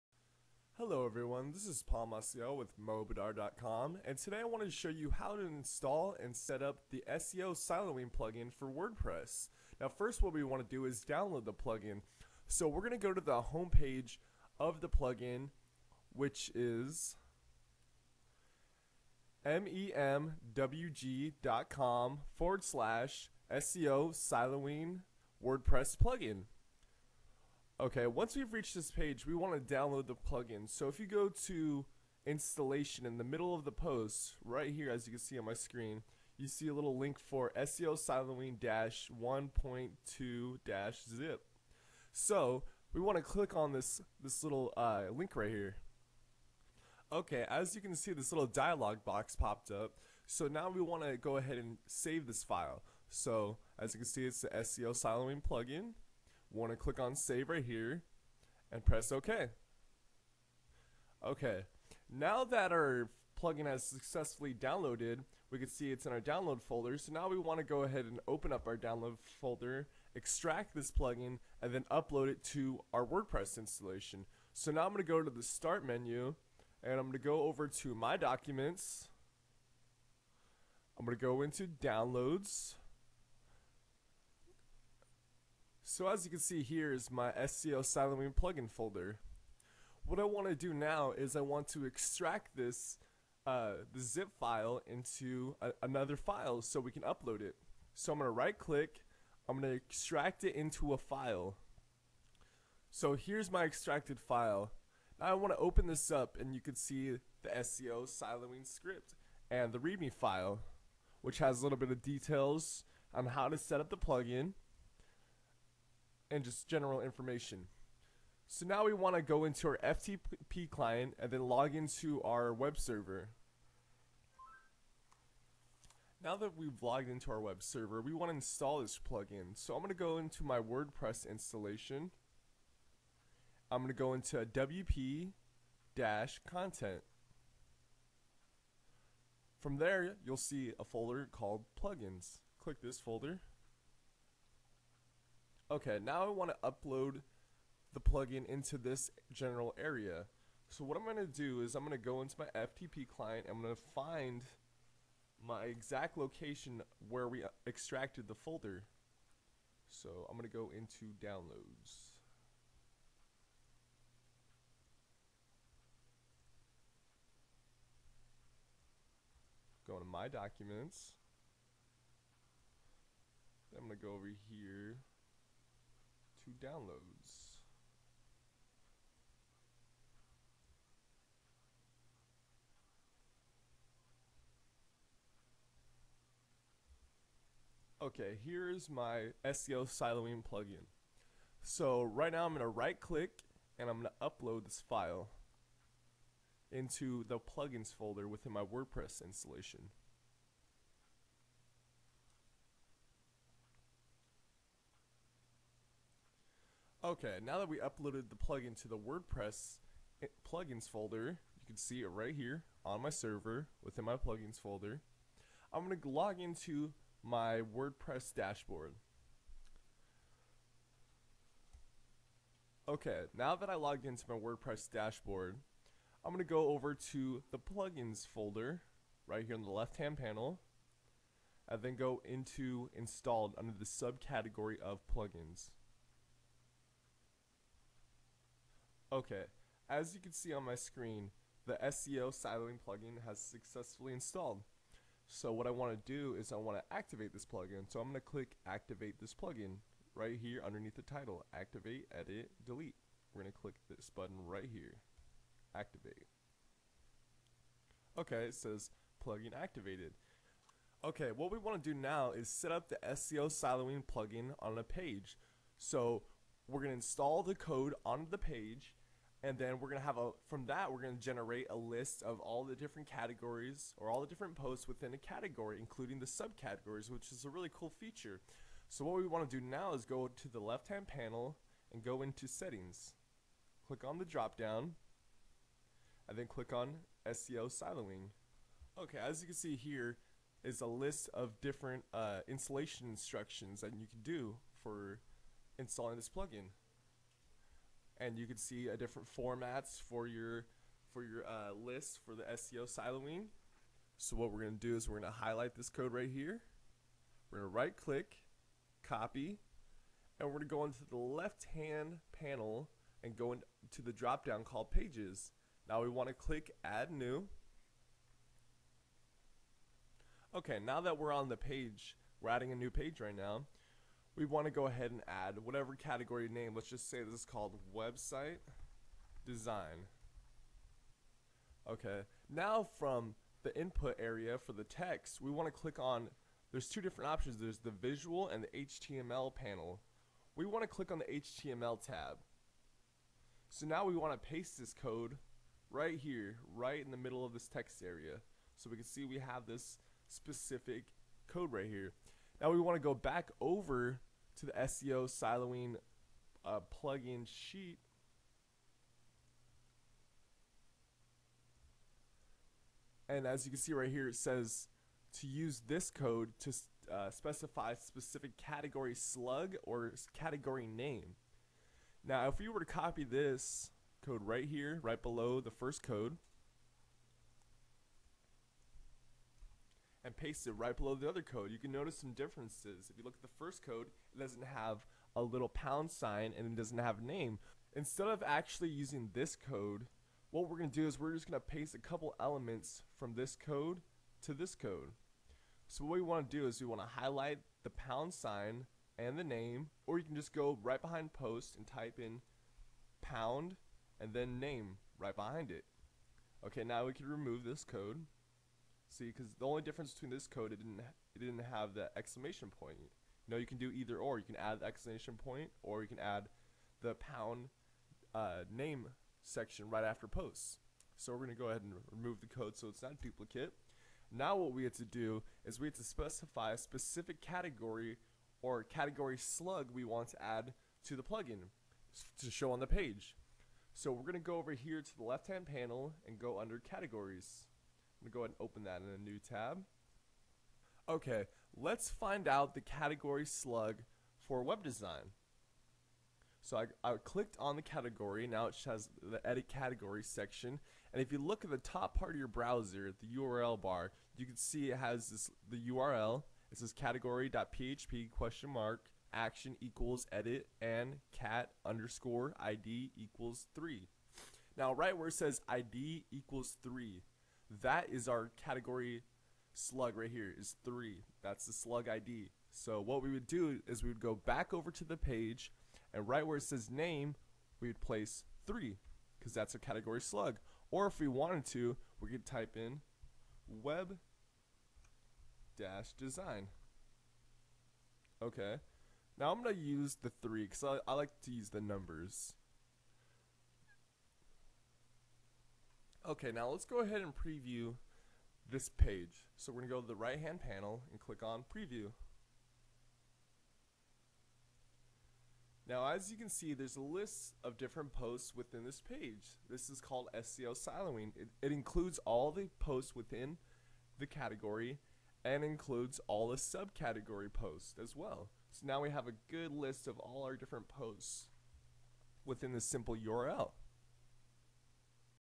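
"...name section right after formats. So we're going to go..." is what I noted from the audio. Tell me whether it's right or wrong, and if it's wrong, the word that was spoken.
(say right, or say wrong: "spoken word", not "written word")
wrong: "posts", not "formats".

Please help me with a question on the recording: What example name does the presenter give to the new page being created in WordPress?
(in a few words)
website design.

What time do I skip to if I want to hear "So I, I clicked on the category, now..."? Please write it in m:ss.
7:26.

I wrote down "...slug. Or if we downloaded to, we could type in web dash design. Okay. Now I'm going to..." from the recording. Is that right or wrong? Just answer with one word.
wrong.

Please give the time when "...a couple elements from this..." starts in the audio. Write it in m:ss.
6:31.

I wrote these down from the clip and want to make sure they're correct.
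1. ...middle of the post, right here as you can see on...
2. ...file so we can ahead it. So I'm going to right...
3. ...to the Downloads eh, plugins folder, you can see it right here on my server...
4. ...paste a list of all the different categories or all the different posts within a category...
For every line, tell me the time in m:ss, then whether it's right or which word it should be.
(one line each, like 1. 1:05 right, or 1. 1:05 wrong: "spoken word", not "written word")
1. 0:33 right
2. 1:36 wrong: "upload", not "ahead"
3. 3:28 wrong: "WordPress", not "Downloads"
4. 4:31 wrong: "generate", not "paste".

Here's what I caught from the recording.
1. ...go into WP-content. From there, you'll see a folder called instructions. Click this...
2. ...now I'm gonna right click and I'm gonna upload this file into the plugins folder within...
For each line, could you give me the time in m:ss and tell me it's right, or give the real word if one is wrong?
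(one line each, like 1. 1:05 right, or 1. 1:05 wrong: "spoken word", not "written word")
1. 2:13 wrong: "plugins", not "instructions"
2. 3:12 right.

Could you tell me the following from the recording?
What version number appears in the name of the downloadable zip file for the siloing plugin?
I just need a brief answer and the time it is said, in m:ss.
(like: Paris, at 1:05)
1.2, at 0:39.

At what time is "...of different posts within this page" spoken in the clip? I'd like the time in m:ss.
8:27.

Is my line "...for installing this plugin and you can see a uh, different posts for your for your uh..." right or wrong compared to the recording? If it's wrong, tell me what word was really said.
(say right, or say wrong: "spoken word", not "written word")
wrong: "formats", not "posts".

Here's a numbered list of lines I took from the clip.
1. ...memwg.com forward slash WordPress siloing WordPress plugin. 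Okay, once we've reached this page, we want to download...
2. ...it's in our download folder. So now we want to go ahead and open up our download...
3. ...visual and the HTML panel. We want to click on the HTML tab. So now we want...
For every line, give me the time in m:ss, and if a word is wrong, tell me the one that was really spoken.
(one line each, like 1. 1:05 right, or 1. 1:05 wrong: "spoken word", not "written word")
1. 0:19 wrong: "SEO", not "WordPress"
2. 1:05 right
3. 5:37 right.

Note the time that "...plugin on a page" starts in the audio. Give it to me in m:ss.
4:24.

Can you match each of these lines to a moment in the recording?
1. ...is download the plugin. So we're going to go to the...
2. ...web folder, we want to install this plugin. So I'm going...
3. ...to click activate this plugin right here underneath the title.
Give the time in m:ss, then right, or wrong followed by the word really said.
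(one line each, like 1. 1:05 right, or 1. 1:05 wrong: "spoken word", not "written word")
1. 0:10 right
2. 2:07 wrong: "server", not "folder"
3. 4:08 right.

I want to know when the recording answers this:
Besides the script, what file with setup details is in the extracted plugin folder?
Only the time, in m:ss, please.
1:49.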